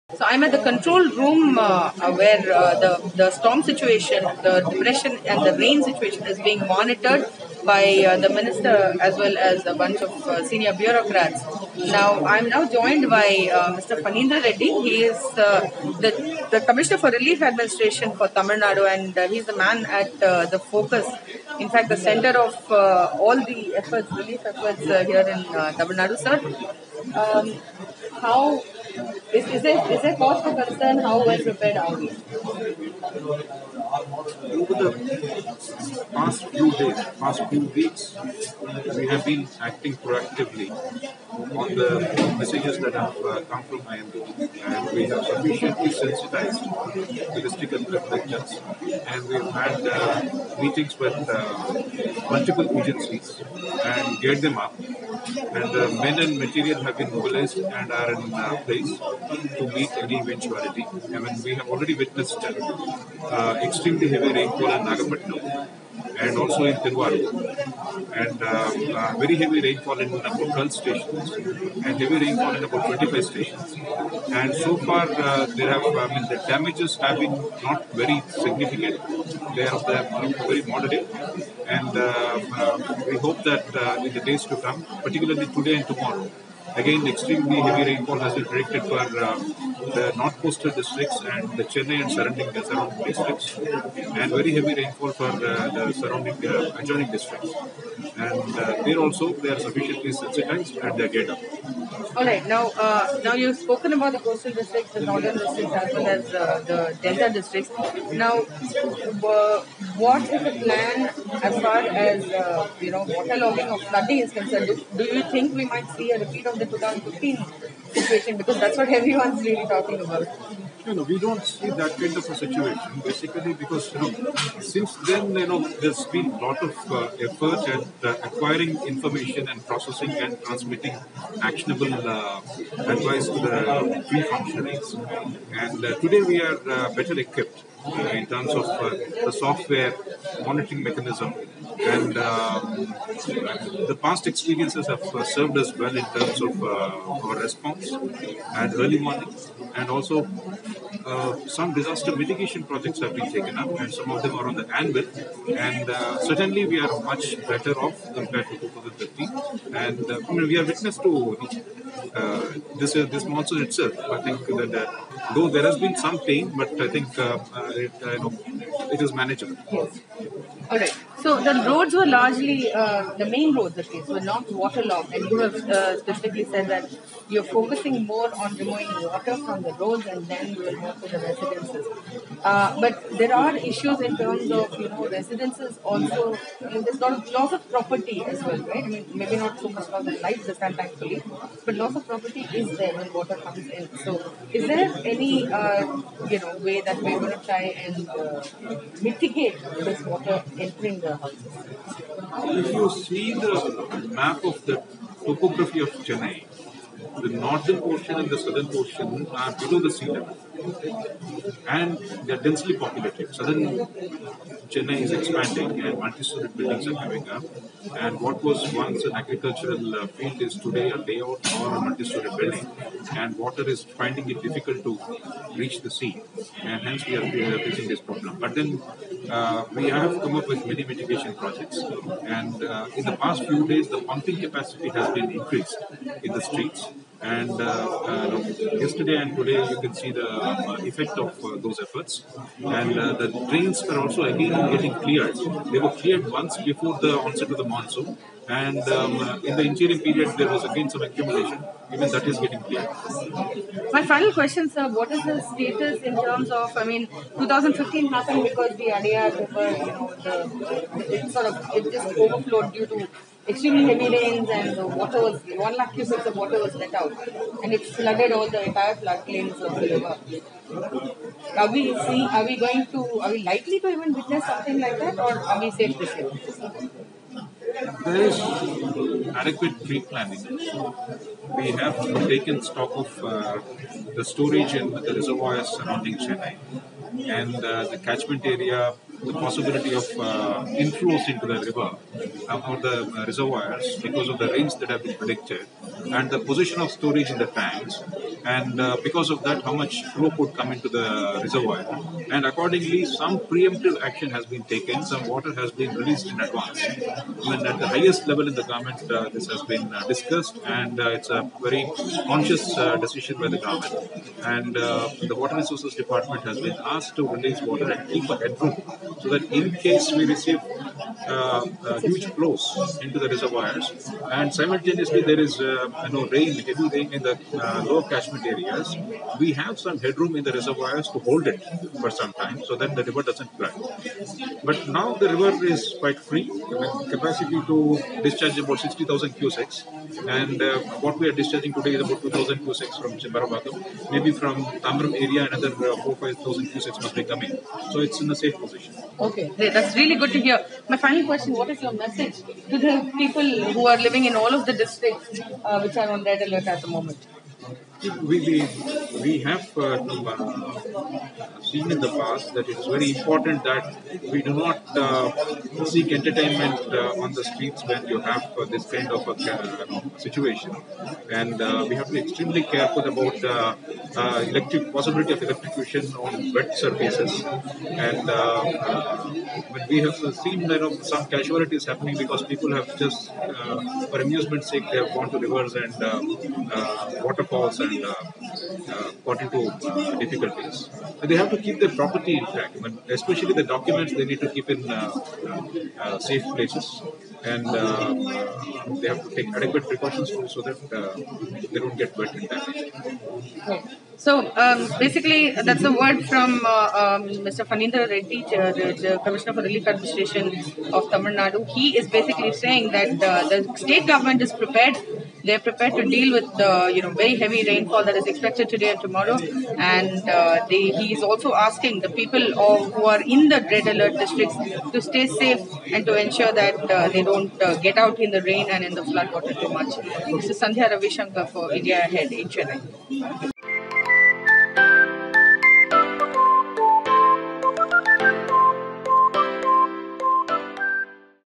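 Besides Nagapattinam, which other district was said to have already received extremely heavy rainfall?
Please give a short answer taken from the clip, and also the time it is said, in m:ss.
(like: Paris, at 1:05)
Tiruvarur, at 1:06.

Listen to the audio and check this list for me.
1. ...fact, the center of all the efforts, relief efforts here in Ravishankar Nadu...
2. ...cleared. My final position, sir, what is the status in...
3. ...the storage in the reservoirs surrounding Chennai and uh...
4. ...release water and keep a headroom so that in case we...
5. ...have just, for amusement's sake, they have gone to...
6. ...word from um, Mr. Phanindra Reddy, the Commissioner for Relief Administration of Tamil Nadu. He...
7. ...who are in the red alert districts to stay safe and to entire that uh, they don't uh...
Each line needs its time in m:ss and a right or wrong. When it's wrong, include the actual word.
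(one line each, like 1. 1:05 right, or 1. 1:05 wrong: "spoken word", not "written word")
1. 0:21 wrong: "Tamil", not "Ravishankar"
2. 4:12 wrong: "question", not "position"
3. 4:44 right
4. 5:17 right
5. 6:22 right
6. 6:45 right
7. 7:02 wrong: "ensure", not "entire".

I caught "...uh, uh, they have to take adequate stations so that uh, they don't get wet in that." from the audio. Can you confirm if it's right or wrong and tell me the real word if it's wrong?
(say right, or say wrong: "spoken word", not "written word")
wrong: "precautions", not "stations".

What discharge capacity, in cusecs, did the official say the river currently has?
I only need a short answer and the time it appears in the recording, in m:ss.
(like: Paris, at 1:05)
60,000 cusecs, at 5:38.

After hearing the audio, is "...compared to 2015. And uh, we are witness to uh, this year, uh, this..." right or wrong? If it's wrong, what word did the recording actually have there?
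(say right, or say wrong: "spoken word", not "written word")
right.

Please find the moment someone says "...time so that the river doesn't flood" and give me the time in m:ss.
5:32.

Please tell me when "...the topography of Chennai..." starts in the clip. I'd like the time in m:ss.
3:24.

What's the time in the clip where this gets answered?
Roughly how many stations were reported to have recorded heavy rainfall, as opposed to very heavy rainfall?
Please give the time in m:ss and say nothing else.
1:12.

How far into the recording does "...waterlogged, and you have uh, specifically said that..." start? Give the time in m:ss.
2:54.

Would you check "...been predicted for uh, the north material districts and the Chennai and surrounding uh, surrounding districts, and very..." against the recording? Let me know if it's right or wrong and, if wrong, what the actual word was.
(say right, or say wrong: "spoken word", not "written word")
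wrong: "coastal", not "material".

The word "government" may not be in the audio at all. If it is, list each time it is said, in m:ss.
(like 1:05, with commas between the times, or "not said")
5:08, 5:13, 6:54.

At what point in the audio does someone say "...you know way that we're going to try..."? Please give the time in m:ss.
3:16.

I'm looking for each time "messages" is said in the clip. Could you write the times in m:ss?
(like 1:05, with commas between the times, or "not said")
0:42, 5:51.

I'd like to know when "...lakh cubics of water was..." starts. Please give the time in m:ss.
4:25.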